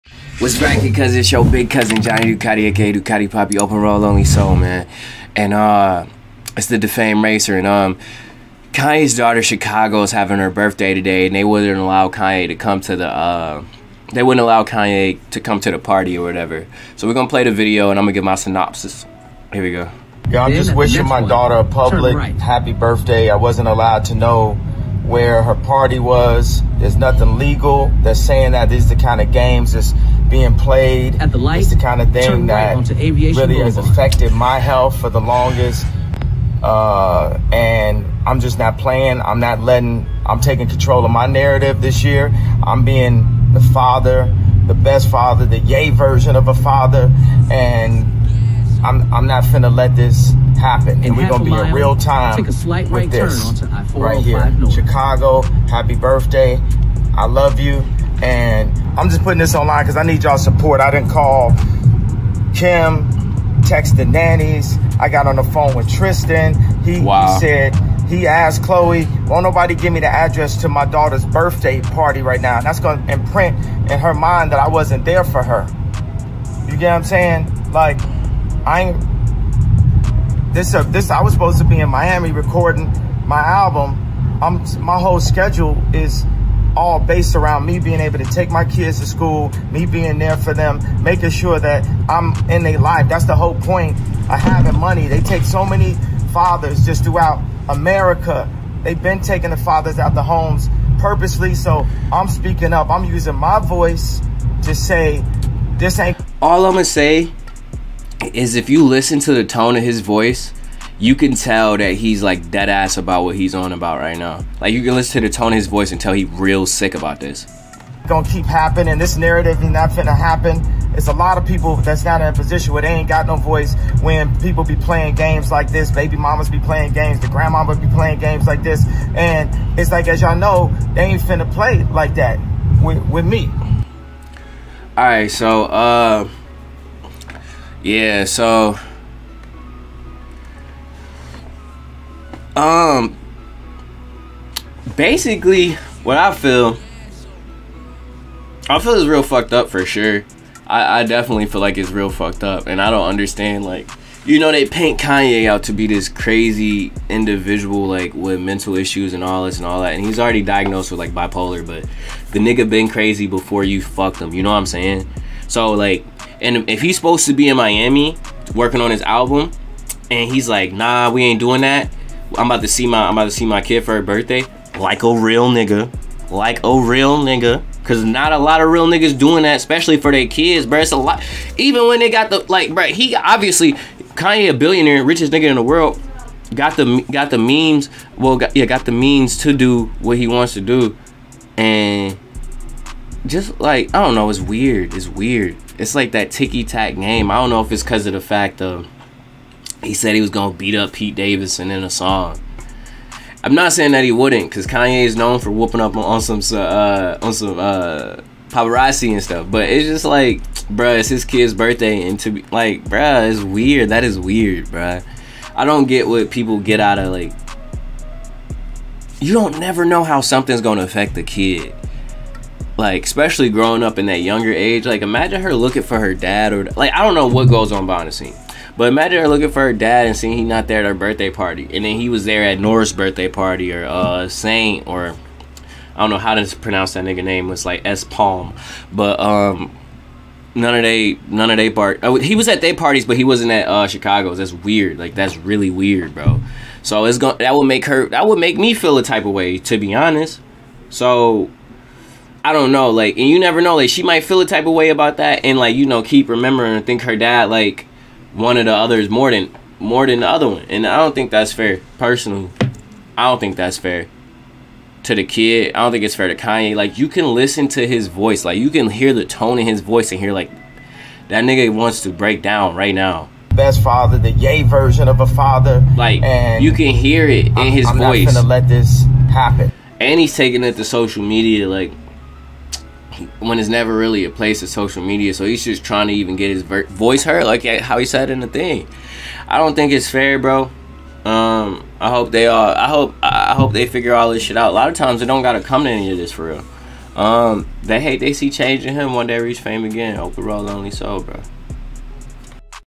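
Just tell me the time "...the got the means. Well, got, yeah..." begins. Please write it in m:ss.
3:06.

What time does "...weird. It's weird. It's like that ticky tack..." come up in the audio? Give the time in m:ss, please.
3:14.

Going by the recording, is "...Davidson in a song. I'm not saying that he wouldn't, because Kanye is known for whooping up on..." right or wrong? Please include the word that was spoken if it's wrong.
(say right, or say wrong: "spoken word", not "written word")
right.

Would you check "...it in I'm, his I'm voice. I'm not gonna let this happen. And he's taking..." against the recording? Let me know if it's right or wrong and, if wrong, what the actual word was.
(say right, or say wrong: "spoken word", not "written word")
right.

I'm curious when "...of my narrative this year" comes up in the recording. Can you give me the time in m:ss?
0:41.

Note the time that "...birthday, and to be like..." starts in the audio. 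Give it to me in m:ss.
3:31.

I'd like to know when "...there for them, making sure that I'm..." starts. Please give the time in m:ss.
1:30.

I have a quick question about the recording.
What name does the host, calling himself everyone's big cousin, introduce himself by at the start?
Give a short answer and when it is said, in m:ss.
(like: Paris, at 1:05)
Johnny Ducati, at 0:02.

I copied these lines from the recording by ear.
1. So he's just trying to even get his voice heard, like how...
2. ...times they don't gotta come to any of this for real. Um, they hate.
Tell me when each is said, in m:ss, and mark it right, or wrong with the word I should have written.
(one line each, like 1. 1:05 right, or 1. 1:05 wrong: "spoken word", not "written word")
1. 4:45 right
2. 4:54 right.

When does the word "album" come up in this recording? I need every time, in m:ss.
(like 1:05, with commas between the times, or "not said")
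1:23, 2:49.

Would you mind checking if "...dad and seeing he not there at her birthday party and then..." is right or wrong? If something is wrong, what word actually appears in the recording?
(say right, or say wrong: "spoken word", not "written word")
right.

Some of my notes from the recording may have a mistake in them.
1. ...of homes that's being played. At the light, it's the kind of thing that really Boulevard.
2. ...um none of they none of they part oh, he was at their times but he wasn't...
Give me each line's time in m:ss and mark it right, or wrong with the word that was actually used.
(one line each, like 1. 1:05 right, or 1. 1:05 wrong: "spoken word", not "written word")
1. 0:29 wrong: "games", not "homes"
2. 3:59 wrong: "parties", not "times".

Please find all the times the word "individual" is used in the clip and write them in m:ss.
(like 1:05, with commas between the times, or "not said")
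2:37.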